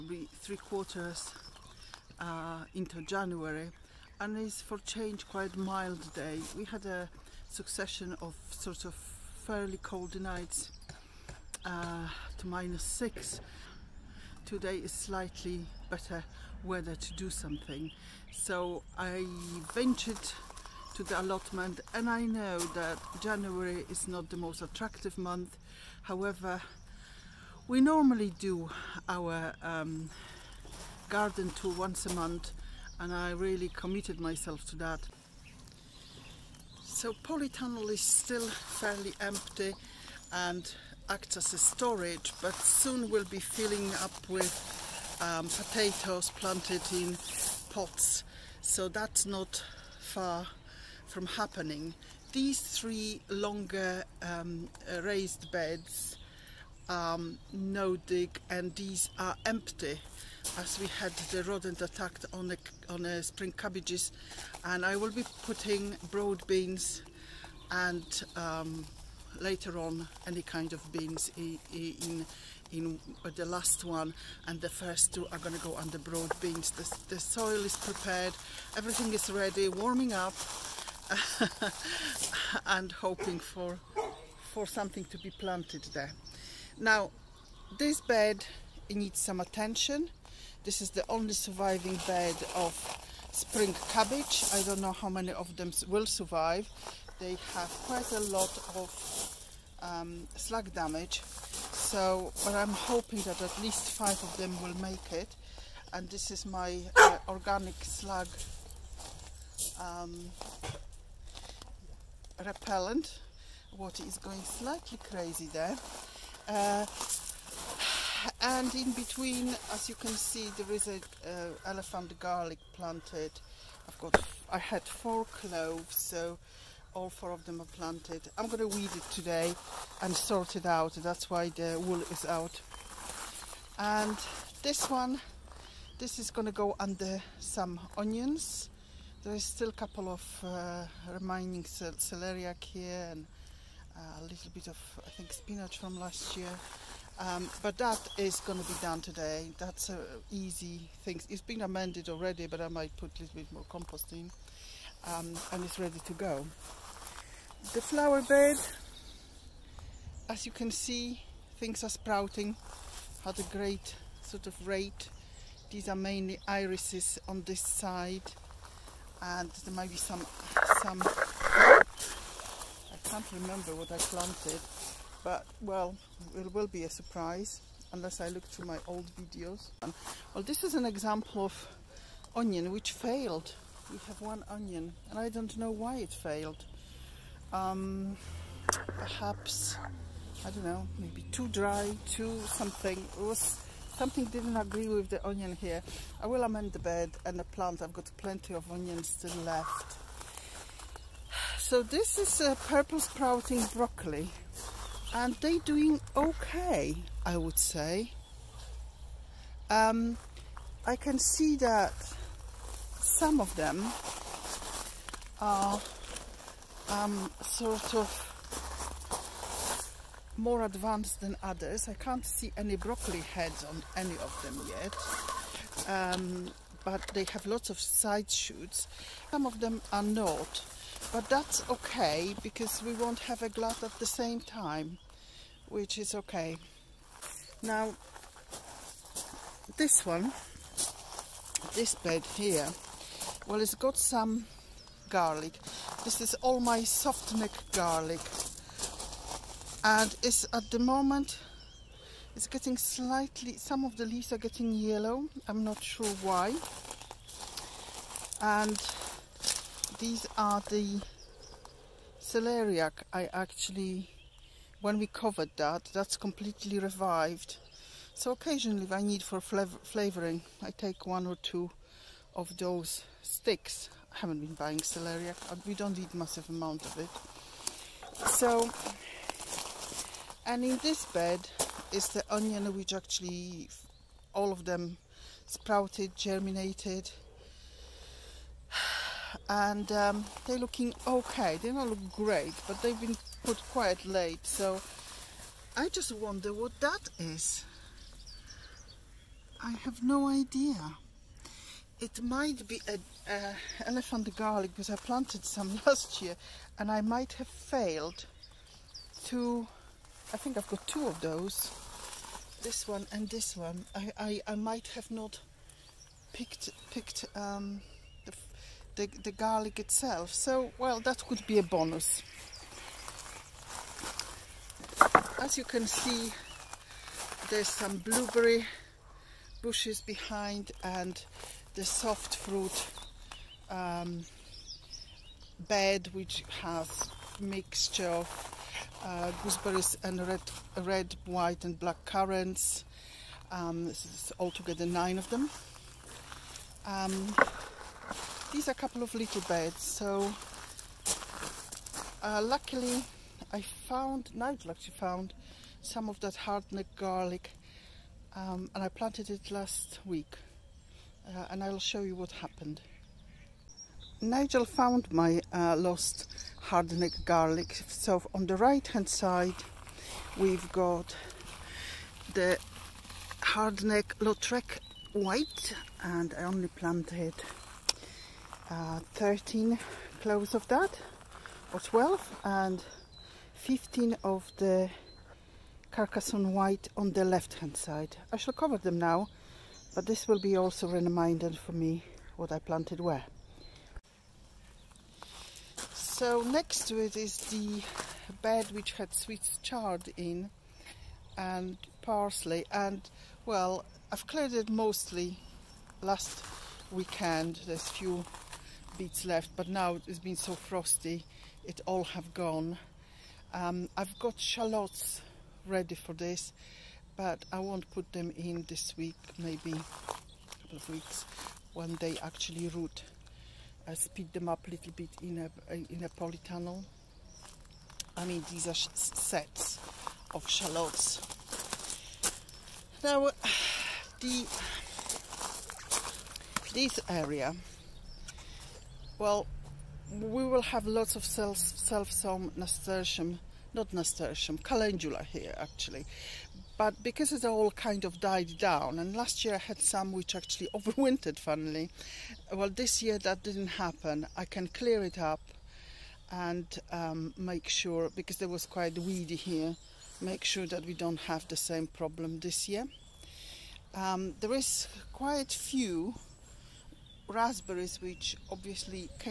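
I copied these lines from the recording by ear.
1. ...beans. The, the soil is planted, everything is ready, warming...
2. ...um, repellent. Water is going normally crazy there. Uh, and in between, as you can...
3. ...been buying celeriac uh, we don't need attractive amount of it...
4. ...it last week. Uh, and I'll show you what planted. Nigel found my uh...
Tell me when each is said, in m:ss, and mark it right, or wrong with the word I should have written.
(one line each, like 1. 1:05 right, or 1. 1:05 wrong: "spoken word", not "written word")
1. 1:16 wrong: "prepared", not "planted"
2. 1:49 wrong: "slightly", not "normally"
3. 4:34 wrong: "massive", not "attractive"
4. 5:59 wrong: "happened", not "planted".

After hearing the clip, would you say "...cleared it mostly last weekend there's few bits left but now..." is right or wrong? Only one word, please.
right.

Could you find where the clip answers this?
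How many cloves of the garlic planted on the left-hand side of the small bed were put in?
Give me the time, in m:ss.
6:23.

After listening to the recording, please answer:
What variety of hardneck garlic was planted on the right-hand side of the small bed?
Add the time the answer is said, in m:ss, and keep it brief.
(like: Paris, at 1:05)
Lautrec Wight, at 6:14.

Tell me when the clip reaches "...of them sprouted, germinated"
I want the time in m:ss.
4:44.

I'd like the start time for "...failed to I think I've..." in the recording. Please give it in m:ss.
5:07.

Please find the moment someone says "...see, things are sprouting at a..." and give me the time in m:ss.
2:40.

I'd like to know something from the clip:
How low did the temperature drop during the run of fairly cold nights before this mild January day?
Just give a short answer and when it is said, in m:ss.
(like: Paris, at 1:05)
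-6, at 0:12.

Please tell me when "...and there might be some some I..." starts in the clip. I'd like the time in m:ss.
2:49.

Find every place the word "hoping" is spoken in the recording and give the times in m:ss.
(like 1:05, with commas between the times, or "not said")
1:22, 1:42.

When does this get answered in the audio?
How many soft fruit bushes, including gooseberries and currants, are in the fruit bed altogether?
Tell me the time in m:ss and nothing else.
5:44.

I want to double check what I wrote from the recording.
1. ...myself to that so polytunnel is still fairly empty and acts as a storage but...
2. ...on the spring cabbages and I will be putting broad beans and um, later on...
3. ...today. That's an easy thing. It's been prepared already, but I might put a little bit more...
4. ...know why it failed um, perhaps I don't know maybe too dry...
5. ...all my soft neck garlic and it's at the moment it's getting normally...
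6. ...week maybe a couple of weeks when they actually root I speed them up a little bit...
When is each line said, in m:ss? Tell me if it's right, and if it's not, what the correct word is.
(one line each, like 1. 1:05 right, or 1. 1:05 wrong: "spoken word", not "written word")
1. 0:34 right
2. 1:02 right
3. 2:29 wrong: "amended", not "prepared"
4. 3:05 right
5. 4:06 wrong: "slightly", not "normally"
6. 6:58 right.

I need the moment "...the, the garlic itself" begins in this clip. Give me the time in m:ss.
5:18.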